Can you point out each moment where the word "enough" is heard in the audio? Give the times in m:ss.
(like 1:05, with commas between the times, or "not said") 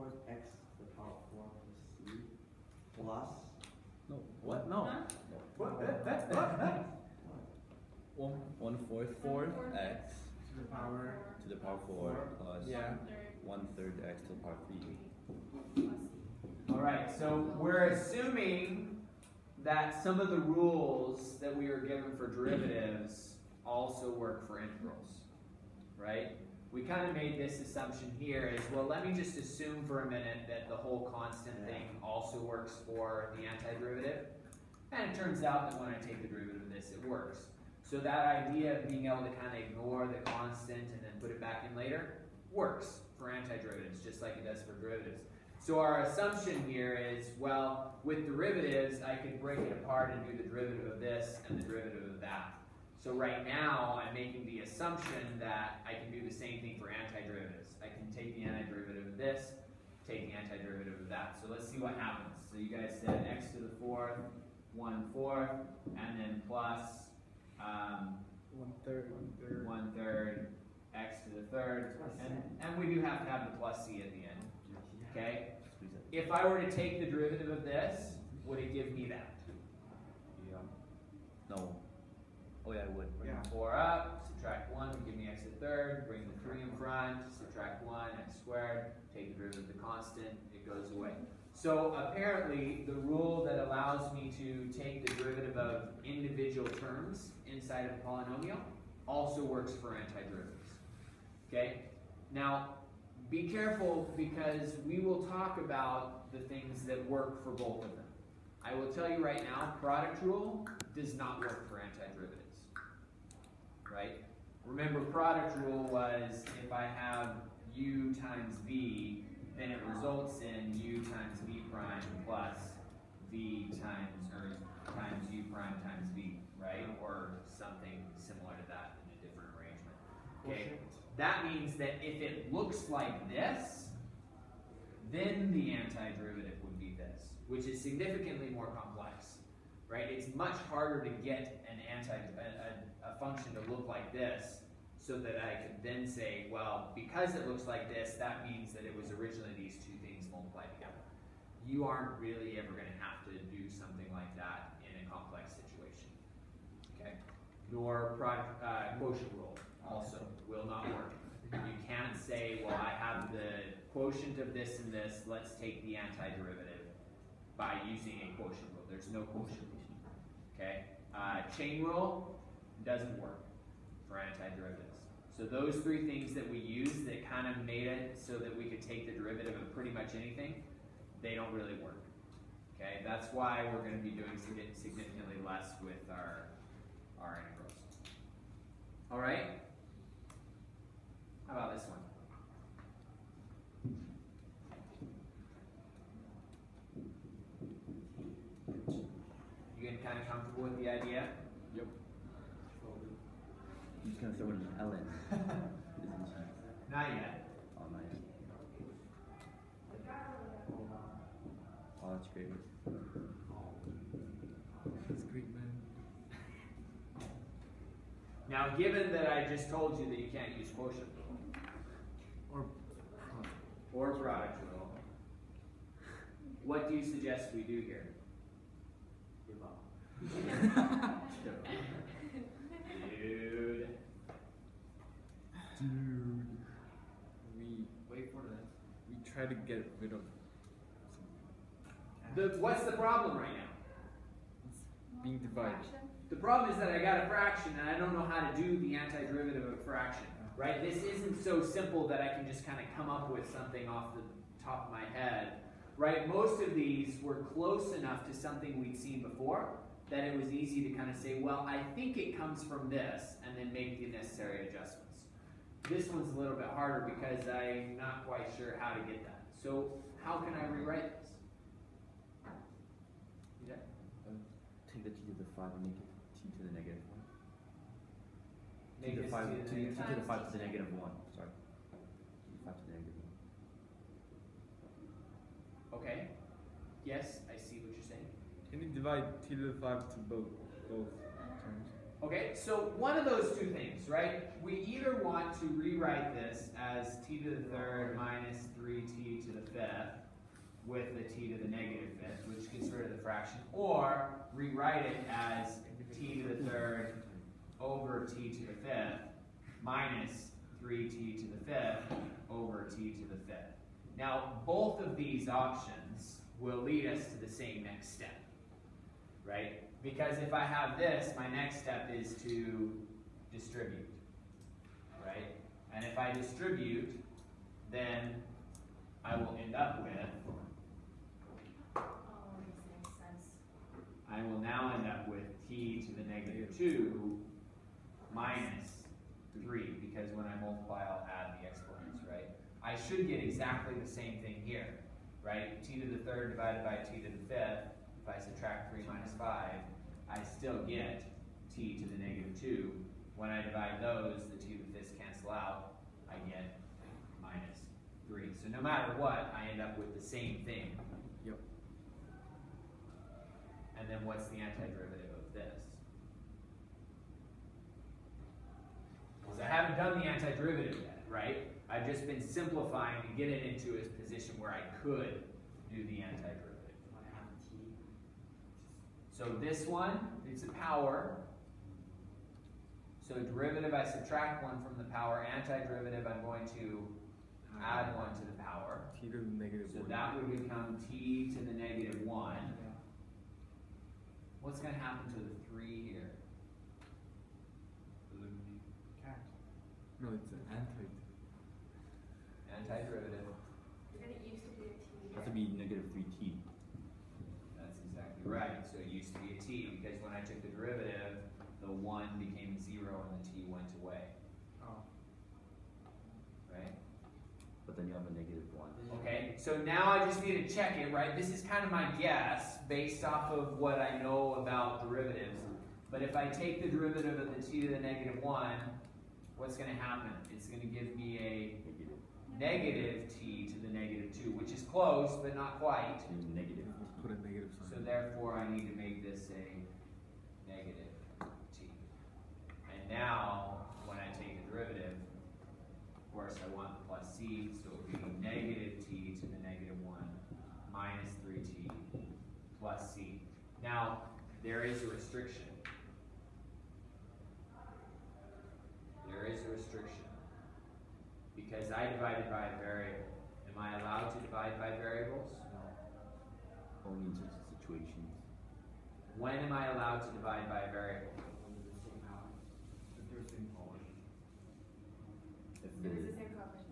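4:17.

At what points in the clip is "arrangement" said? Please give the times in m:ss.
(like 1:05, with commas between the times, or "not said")
2:09.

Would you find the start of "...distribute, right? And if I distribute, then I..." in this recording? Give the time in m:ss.
5:23.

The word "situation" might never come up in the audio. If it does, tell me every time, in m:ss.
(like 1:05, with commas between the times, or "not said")
2:35.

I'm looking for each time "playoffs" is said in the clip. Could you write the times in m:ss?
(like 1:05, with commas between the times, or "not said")
not said.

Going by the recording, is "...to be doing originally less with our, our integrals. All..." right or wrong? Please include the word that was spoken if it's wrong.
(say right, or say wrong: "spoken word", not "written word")
wrong: "significantly", not "originally".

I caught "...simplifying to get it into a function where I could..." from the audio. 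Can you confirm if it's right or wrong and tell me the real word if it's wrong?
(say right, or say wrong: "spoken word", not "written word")
wrong: "position", not "function".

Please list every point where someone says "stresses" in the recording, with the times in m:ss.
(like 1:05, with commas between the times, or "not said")
not said.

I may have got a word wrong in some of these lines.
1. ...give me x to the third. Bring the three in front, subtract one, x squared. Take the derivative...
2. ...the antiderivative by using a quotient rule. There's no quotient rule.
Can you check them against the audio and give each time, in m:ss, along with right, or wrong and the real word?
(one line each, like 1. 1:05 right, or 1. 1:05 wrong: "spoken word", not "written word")
1. 1:25 right
2. 2:45 right.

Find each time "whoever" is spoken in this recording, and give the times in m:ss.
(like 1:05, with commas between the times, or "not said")
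not said.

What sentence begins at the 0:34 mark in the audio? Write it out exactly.
And it turns out that when I take the derivative of this, it works.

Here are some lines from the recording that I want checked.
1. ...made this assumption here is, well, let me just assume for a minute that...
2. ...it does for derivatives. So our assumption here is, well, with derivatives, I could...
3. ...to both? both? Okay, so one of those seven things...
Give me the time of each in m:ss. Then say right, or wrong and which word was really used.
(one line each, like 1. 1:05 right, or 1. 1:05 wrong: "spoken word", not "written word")
1. 0:27 right
2. 0:44 right
3. 4:50 wrong: "two", not "seven".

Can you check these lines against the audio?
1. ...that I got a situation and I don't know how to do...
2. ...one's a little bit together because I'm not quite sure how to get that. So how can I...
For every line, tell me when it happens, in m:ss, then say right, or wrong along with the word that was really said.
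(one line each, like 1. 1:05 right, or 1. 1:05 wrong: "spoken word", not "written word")
1. 4:06 wrong: "fraction", not "situation"
2. 4:26 wrong: "harder", not "together".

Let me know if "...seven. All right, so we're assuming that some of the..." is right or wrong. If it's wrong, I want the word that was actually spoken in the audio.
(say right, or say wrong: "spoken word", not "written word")
wrong: "three", not "seven".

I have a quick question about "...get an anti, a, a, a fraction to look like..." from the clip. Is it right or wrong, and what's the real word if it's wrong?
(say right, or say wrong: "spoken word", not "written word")
wrong: "function", not "fraction".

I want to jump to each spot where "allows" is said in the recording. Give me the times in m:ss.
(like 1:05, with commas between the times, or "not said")
1:33.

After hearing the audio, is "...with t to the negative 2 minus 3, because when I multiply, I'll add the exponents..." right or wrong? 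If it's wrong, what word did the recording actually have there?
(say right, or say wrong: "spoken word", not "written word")
right.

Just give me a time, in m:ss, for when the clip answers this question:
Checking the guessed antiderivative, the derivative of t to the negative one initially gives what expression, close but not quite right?
7:13.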